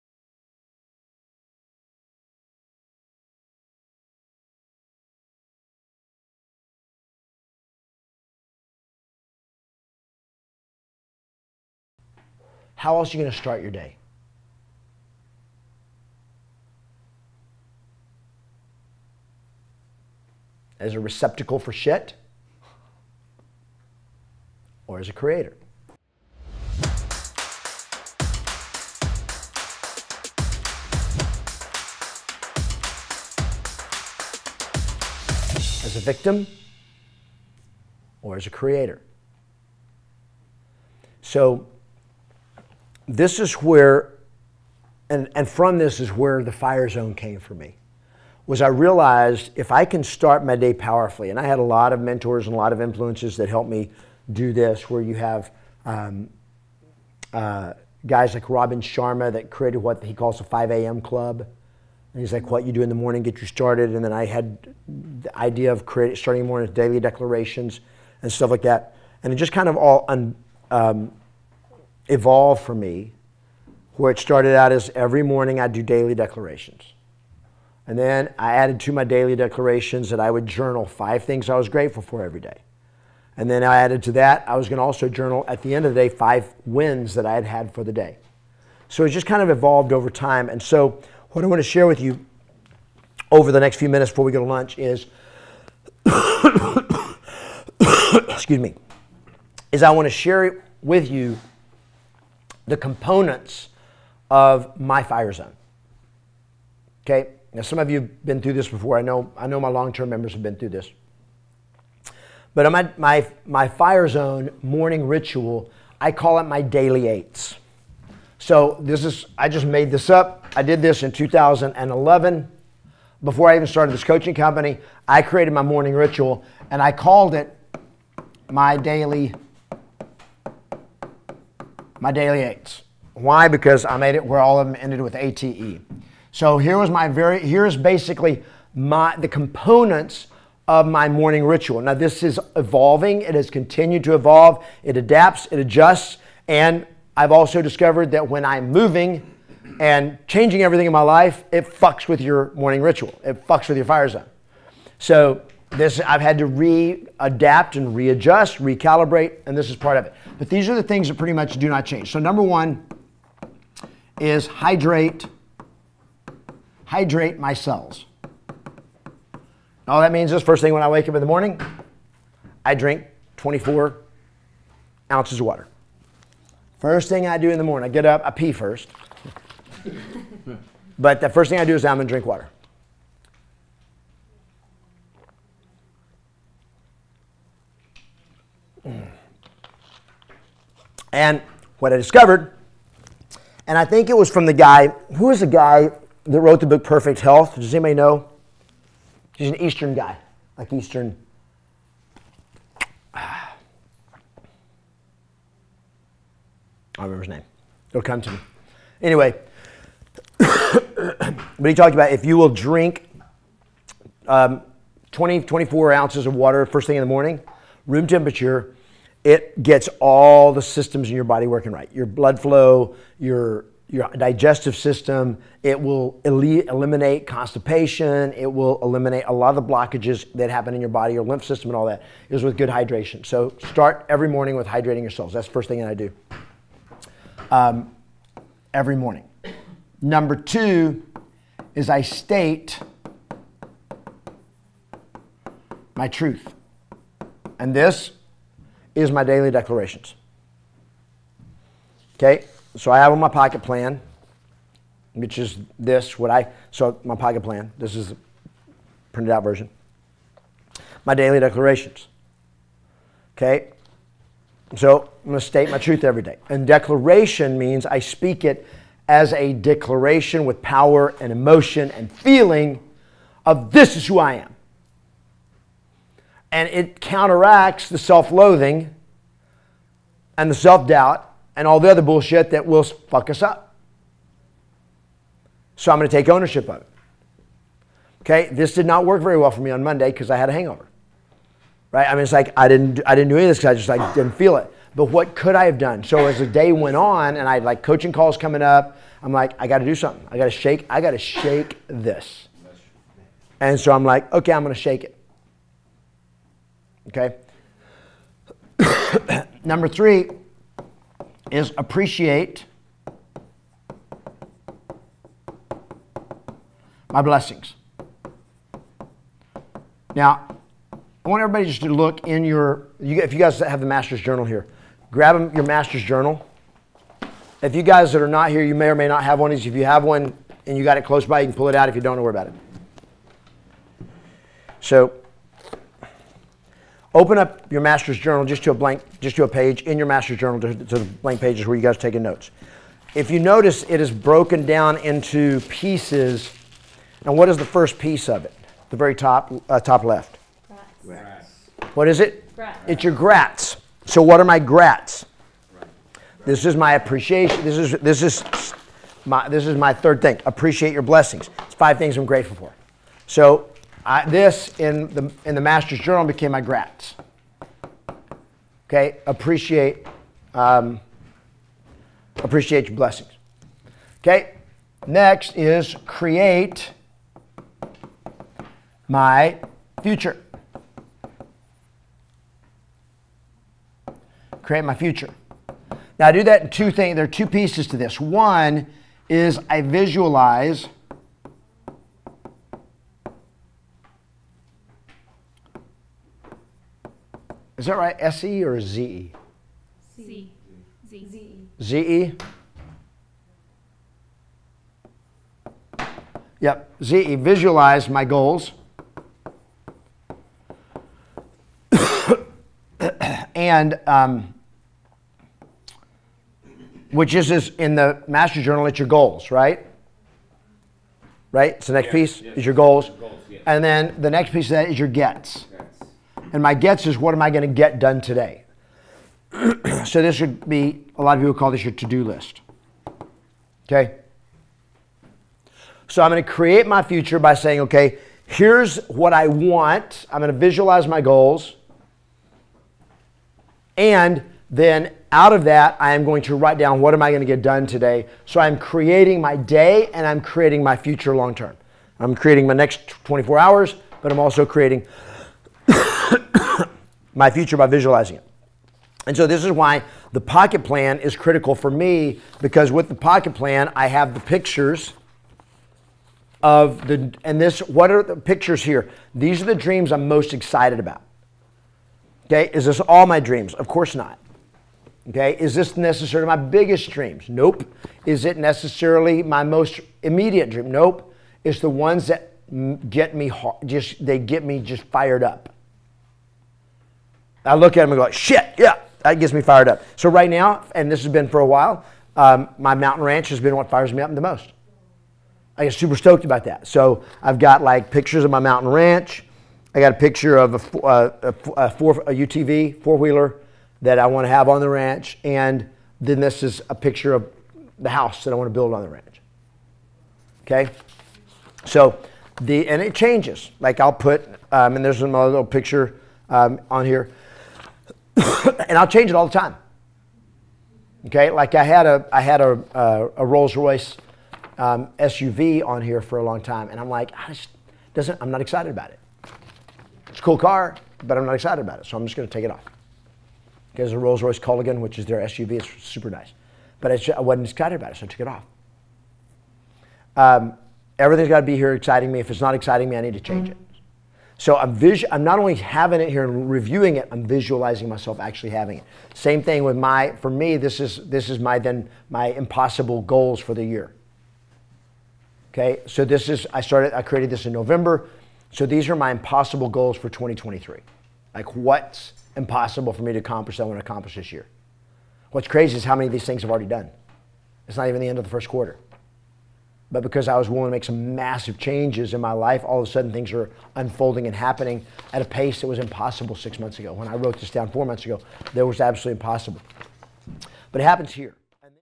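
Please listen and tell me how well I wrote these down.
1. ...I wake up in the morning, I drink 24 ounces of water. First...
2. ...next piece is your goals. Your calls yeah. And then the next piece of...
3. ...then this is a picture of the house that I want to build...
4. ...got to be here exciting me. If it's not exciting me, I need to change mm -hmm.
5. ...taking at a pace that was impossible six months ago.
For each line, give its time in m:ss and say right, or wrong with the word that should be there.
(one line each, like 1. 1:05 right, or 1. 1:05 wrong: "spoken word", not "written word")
1. 2:50 right
2. 7:01 wrong: "goals", not "calls"
3. 8:26 right
4. 9:01 right
5. 9:34 wrong: "happening", not "taking".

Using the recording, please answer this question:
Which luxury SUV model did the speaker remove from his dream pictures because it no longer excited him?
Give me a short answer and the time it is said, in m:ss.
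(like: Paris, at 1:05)
Rolls Royce Cullinan, at 8:54.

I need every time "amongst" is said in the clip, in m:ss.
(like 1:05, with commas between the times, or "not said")
not said.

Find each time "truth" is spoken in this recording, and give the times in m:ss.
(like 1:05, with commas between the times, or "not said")
4:06, 4:25.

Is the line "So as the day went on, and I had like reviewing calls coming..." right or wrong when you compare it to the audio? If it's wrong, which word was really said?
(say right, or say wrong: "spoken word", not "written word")
wrong: "coaching", not "reviewing".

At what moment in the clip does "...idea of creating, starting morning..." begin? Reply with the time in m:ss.
1:05.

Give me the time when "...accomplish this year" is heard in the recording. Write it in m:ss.
9:24.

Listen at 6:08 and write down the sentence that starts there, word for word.
Okay, appreciate, um, appreciate your blessings.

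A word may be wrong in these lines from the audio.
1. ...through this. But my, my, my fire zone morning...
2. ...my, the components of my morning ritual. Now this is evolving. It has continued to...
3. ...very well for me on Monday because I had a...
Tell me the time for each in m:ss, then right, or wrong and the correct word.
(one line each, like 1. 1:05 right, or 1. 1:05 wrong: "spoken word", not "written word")
1. 1:50 right
2. 2:18 right
3. 4:49 right.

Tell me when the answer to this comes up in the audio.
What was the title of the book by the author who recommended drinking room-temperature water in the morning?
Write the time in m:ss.
3:16.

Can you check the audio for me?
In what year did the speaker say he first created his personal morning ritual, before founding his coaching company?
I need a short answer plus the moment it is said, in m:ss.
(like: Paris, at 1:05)
2011, at 2:01.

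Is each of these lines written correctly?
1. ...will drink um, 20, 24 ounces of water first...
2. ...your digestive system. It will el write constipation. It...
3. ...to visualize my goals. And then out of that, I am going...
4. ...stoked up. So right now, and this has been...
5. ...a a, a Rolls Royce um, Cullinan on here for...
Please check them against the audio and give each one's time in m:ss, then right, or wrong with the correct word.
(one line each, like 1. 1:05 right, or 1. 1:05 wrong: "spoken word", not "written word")
1. 3:32 right
2. 3:43 wrong: "eliminate", not "write"
3. 7:20 right
4. 8:09 wrong: "fired", not "stoked"
5. 8:42 wrong: "SUV", not "Cullinan".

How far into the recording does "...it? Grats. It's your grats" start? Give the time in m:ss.
5:52.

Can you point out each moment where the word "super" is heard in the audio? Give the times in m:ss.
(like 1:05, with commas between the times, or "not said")
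8:15, 8:56.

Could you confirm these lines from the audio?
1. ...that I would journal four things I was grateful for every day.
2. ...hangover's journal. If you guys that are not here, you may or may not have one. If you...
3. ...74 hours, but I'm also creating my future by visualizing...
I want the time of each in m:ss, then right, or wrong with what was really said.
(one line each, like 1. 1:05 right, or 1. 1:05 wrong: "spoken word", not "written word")
1. 1:20 wrong: "five", not "four"
2. 5:25 wrong: "master", not "hangover"
3. 7:33 wrong: "24", not "74".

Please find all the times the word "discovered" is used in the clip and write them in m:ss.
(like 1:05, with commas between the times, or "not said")
2:27, 3:11.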